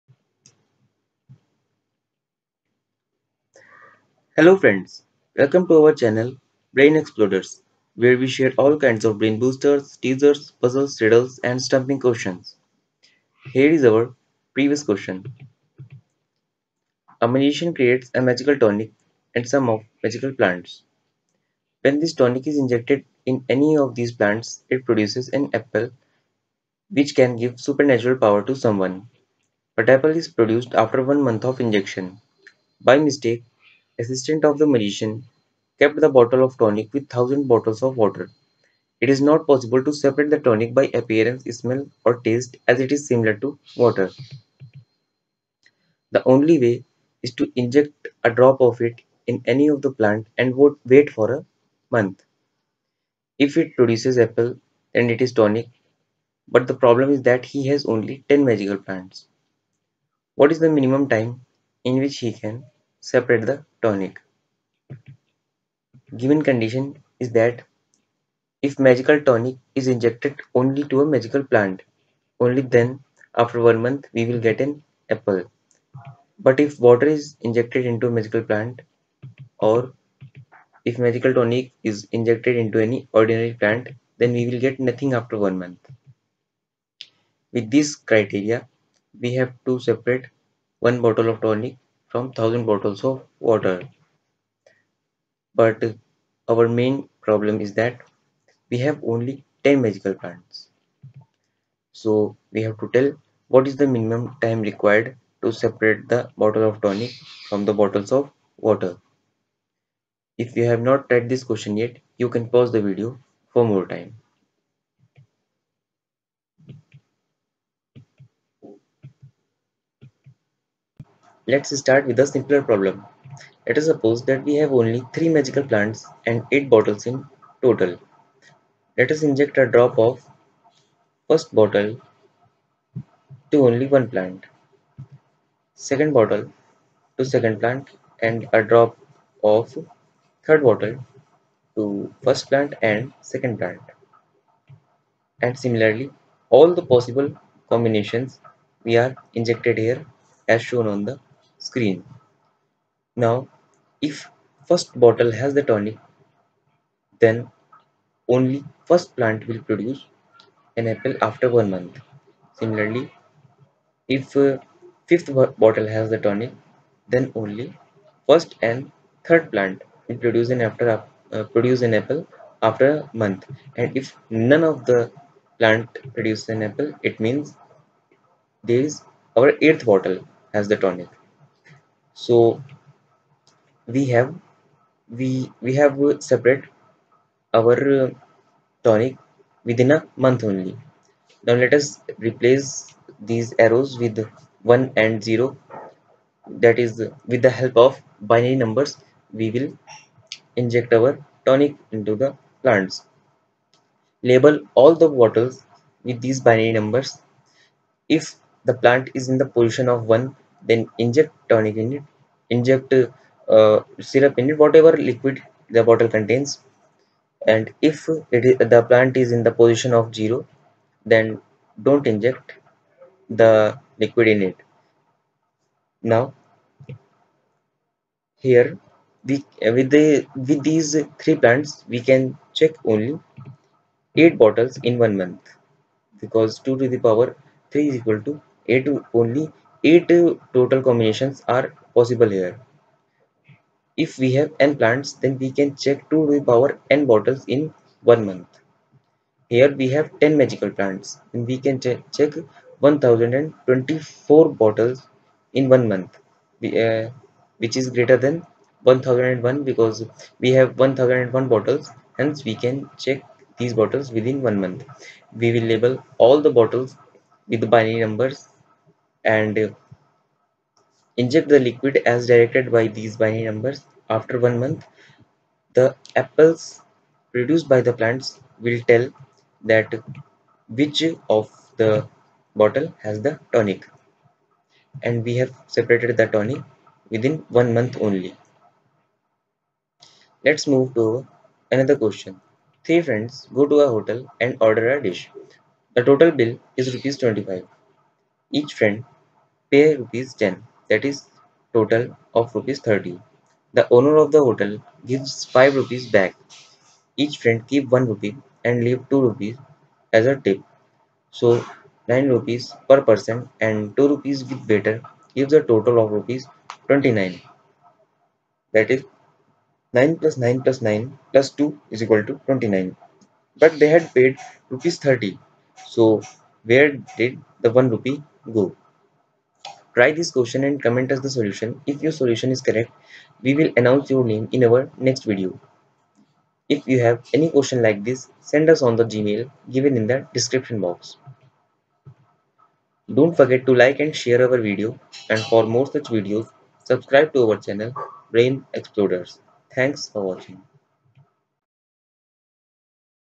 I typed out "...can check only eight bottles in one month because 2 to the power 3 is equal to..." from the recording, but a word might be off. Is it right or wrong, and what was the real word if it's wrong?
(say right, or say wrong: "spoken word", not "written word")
right.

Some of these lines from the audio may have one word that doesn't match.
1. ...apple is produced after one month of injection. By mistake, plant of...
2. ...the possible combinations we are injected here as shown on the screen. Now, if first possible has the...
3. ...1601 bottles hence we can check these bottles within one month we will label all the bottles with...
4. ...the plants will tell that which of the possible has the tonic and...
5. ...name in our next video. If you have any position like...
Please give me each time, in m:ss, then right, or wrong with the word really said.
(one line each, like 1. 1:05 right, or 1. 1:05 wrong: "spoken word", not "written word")
1. 0:29 wrong: "assistant", not "plant"
2. 2:26 wrong: "bottle", not "possible"
3. 4:20 wrong: "1001", not "1601"
4. 4:37 wrong: "bottle", not "possible"
5. 5:34 wrong: "question", not "position".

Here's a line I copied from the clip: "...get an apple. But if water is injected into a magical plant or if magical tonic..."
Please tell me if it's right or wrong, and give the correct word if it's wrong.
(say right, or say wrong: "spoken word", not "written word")
right.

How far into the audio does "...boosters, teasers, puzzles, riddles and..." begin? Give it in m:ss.
0:09.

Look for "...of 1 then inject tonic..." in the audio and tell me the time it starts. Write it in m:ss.
3:29.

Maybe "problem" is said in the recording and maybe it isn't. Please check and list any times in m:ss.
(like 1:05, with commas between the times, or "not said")
0:56, 1:37, 2:02.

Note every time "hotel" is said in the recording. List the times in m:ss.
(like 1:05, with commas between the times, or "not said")
4:53, 5:04.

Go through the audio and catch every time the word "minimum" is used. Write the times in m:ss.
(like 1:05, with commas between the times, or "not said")
1:00, 1:43.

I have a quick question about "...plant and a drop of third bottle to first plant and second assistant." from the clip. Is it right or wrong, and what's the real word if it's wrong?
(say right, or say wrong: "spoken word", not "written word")
wrong: "plant", not "assistant".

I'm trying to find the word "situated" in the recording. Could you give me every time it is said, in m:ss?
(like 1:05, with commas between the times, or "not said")
not said.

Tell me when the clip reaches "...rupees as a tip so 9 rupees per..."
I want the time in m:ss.
5:09.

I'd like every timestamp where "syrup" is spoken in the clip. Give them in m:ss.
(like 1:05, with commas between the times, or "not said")
3:33.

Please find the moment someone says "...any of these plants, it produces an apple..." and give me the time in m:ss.
0:23.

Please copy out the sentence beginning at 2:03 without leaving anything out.
Let us suppose that we have only 3 magical plants and 8 bottles in total.